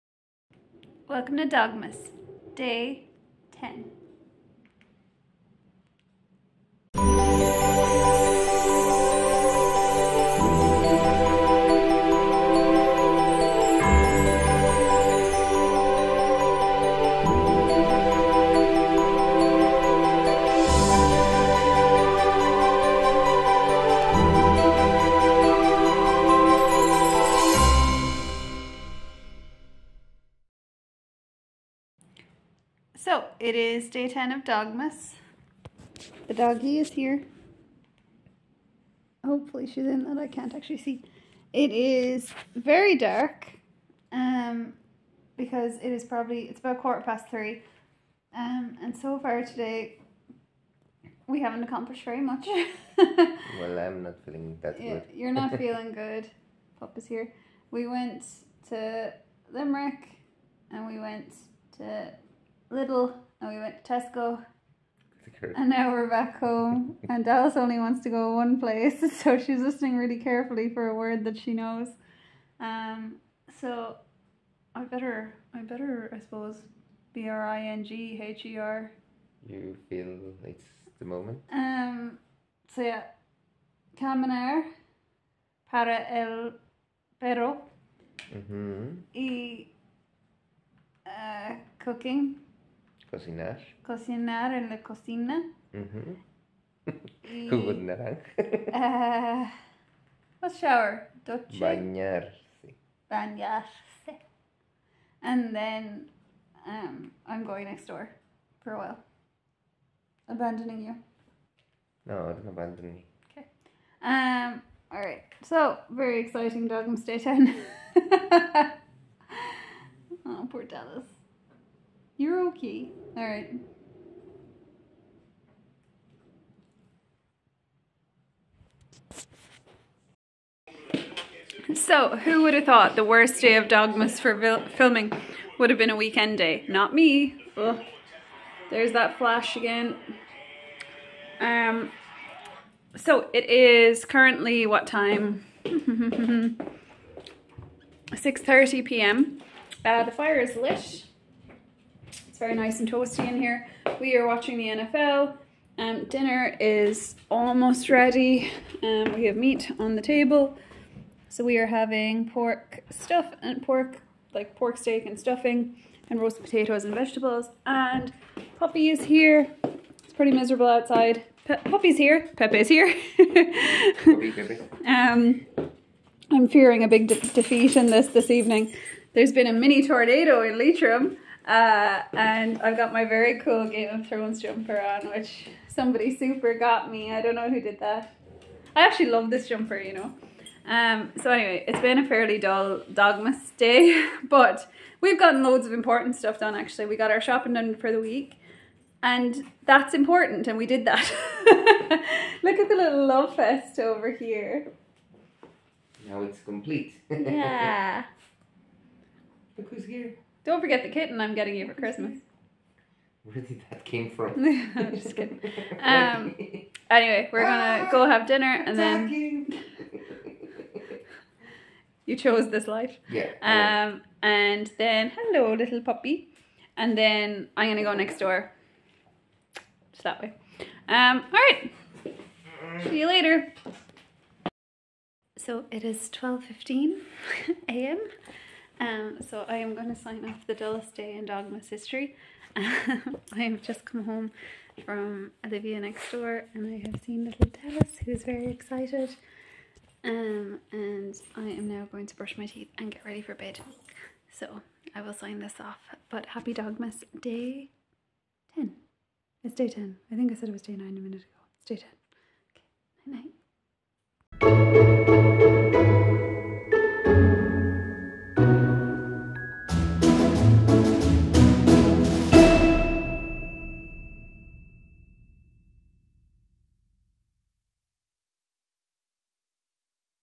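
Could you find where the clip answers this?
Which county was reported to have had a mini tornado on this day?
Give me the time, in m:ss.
3:00.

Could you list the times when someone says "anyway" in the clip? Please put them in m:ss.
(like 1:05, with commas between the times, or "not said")
3:11, 3:36.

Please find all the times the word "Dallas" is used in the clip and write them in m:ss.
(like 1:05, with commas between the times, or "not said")
1:07, 2:00, 4:07.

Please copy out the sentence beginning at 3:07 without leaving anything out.
I don't know who did that.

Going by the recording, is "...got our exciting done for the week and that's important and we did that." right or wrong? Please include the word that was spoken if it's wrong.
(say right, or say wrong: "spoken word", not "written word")
wrong: "shopping", not "exciting".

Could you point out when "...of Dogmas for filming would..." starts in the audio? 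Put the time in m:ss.
2:13.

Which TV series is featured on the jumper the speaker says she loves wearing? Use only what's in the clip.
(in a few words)
Game of Thrones.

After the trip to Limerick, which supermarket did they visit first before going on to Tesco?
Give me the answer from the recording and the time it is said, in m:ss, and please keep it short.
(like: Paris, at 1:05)
Lidl, at 1:02.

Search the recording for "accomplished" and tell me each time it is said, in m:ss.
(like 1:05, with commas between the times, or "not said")
0:51.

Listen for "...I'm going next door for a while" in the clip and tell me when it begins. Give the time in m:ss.
1:47.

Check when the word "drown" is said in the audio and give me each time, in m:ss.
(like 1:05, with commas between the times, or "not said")
not said.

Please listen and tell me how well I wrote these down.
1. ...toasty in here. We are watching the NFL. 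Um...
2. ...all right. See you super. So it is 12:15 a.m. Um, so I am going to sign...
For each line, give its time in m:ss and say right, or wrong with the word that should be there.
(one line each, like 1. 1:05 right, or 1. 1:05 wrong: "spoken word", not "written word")
1. 2:32 right
2. 3:51 wrong: "later", not "super".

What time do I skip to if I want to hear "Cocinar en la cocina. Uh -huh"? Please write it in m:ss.
1:33.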